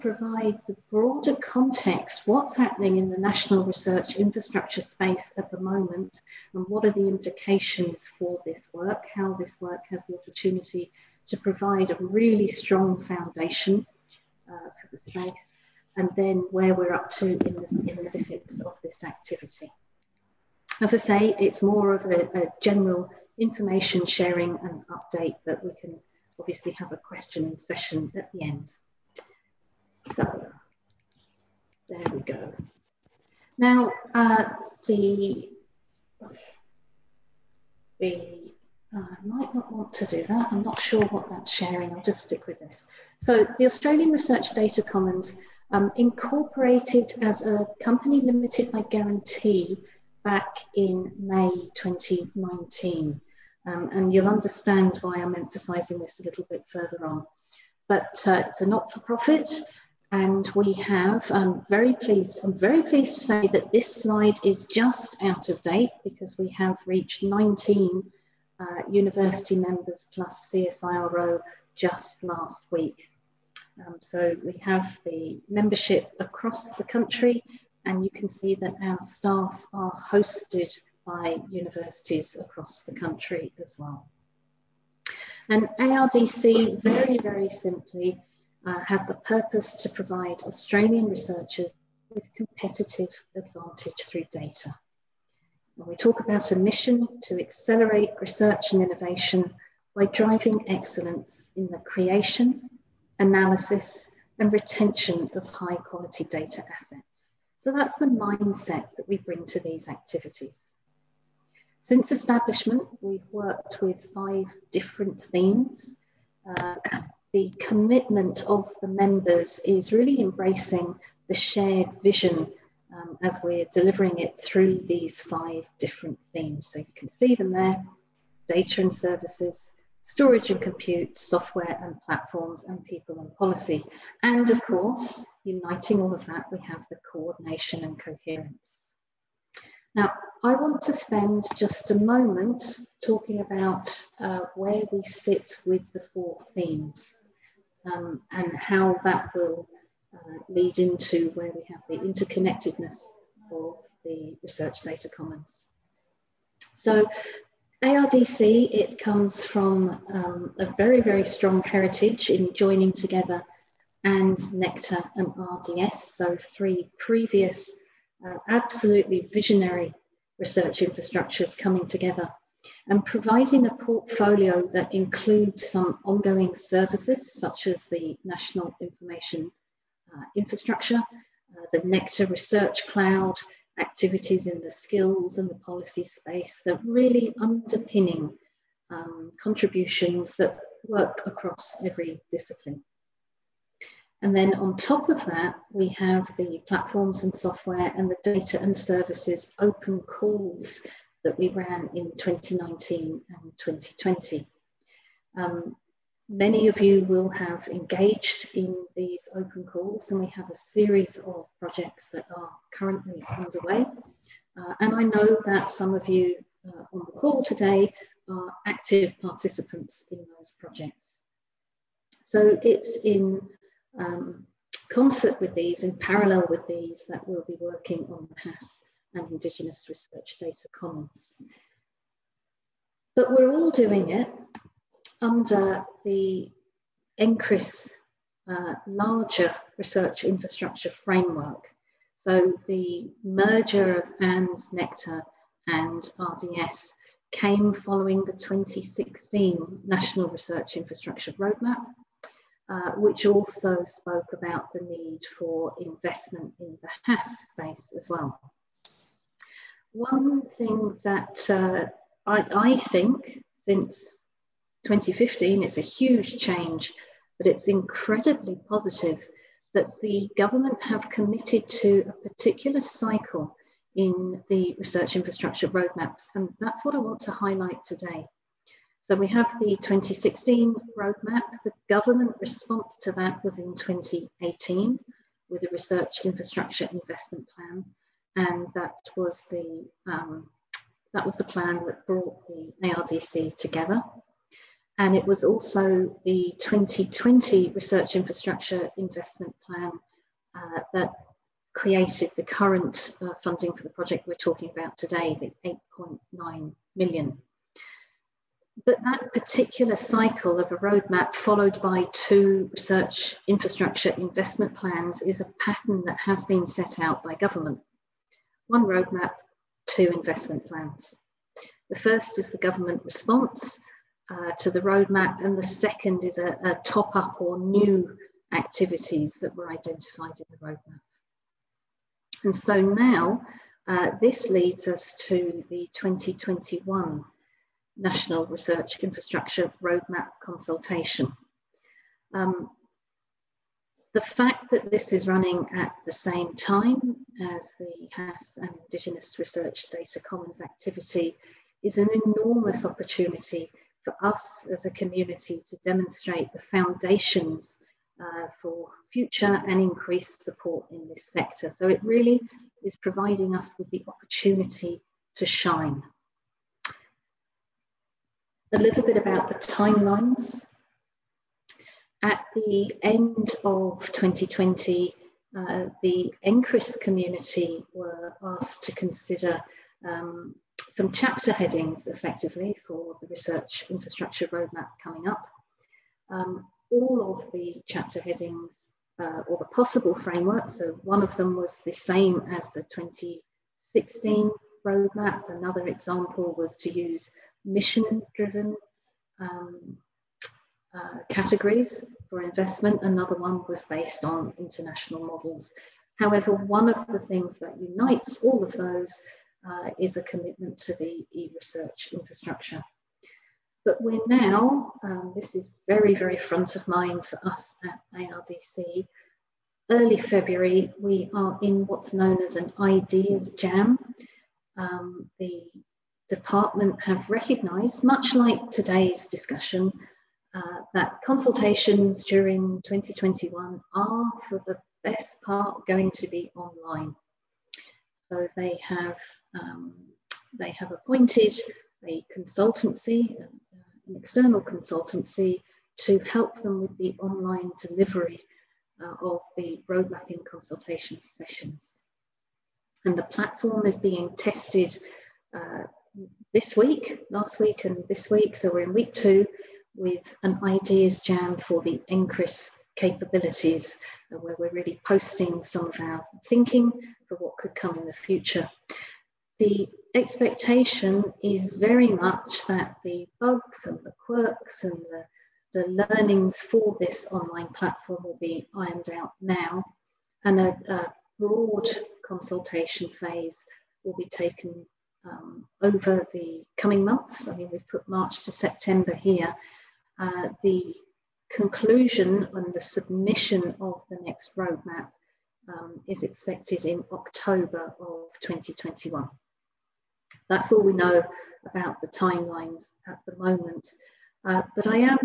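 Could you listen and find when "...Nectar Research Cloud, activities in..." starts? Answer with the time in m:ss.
3:01.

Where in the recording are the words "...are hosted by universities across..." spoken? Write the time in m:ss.
1:19.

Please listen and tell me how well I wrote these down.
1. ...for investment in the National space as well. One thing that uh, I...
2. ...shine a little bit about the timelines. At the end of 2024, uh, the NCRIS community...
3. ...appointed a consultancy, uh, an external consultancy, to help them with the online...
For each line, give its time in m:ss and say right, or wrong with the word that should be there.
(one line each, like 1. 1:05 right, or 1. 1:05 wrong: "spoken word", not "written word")
1. 4:15 wrong: "HASS", not "National"
2. 6:05 wrong: "2020", not "2024"
3. 7:20 right.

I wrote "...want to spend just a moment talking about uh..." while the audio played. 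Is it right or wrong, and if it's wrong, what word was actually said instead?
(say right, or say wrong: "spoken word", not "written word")
right.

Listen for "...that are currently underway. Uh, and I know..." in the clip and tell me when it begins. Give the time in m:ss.
3:32.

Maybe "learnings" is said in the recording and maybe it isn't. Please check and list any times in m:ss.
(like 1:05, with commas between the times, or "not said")
7:56.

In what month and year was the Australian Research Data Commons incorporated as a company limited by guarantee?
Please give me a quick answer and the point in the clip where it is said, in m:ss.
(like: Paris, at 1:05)
May 2019, at 0:51.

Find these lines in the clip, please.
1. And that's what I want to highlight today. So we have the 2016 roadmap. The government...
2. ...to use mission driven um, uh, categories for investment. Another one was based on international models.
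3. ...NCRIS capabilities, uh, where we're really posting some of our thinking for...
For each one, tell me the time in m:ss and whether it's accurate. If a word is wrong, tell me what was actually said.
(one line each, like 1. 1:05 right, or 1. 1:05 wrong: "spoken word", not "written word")
1. 4:36 right
2. 6:36 right
3. 7:42 right.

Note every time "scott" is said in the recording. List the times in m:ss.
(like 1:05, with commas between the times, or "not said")
not said.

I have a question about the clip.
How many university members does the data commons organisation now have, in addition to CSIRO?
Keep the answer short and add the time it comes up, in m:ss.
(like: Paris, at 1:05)
19, at 1:07.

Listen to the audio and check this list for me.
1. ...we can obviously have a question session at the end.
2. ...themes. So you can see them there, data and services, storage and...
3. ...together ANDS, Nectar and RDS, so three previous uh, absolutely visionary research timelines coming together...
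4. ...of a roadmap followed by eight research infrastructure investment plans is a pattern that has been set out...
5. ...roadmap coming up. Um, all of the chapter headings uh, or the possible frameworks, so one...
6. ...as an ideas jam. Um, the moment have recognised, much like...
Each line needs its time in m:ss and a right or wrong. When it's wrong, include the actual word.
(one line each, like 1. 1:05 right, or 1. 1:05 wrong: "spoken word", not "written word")
1. 0:25 right
2. 2:06 right
3. 2:42 wrong: "infrastructures", not "timelines"
4. 5:10 wrong: "two", not "eight"
5. 6:24 right
6. 7:02 wrong: "department", not "moment".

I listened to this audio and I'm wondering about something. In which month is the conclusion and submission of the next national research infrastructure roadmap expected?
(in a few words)
October.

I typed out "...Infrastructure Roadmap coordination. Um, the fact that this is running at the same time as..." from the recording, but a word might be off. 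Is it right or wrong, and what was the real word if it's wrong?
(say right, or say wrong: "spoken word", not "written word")
wrong: "consultation", not "coordination".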